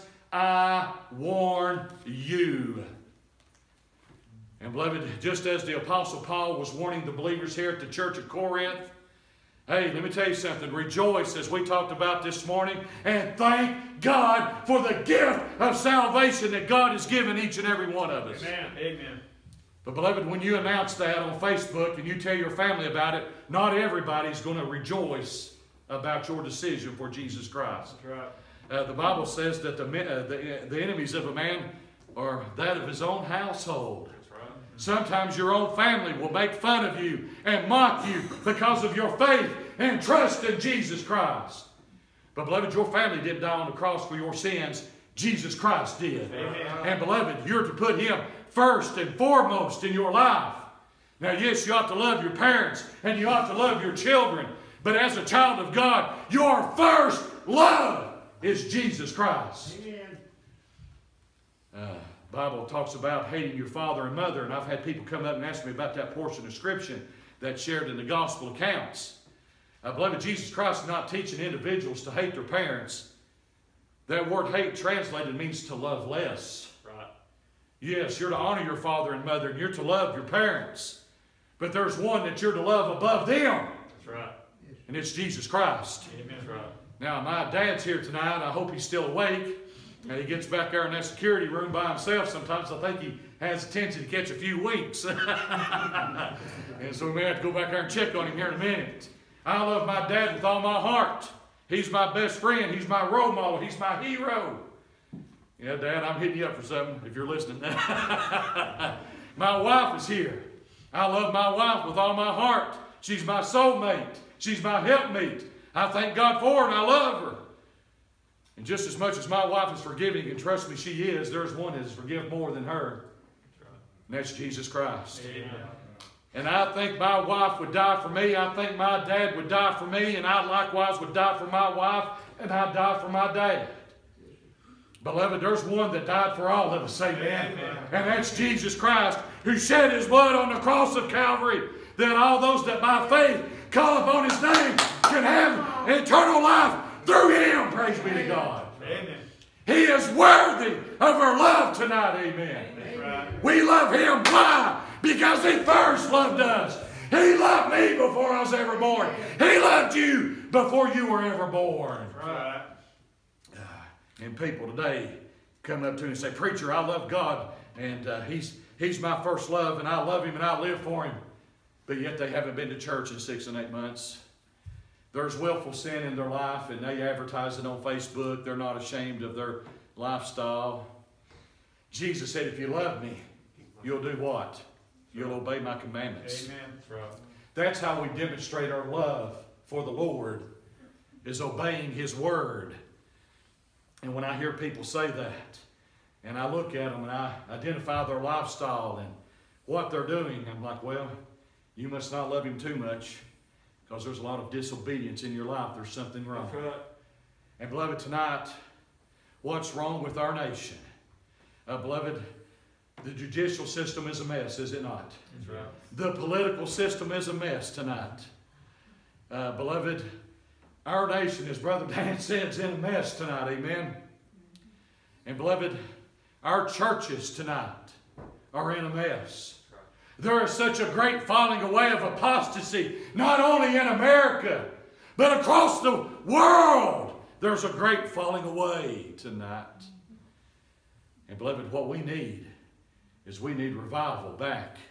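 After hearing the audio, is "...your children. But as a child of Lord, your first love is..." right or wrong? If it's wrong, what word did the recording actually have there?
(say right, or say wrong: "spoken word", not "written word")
wrong: "God", not "Lord".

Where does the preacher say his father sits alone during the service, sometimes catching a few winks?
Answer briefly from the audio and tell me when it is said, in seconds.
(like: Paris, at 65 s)
security room, at 91 s.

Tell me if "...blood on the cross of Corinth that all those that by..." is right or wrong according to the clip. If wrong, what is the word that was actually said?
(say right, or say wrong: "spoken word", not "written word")
wrong: "Calvary", not "Corinth".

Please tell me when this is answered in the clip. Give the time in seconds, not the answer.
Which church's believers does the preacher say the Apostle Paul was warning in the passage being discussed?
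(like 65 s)
7 s.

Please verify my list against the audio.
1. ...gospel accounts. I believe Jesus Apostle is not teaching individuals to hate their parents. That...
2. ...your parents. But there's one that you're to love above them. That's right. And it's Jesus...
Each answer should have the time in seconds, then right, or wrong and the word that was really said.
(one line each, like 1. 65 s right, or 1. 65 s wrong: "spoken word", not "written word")
1. 68 s wrong: "Christ", not "Apostle"
2. 80 s right.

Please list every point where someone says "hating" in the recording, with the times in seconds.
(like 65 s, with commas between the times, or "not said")
63 s.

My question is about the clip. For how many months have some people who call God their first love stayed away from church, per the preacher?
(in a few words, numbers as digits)
six and eight.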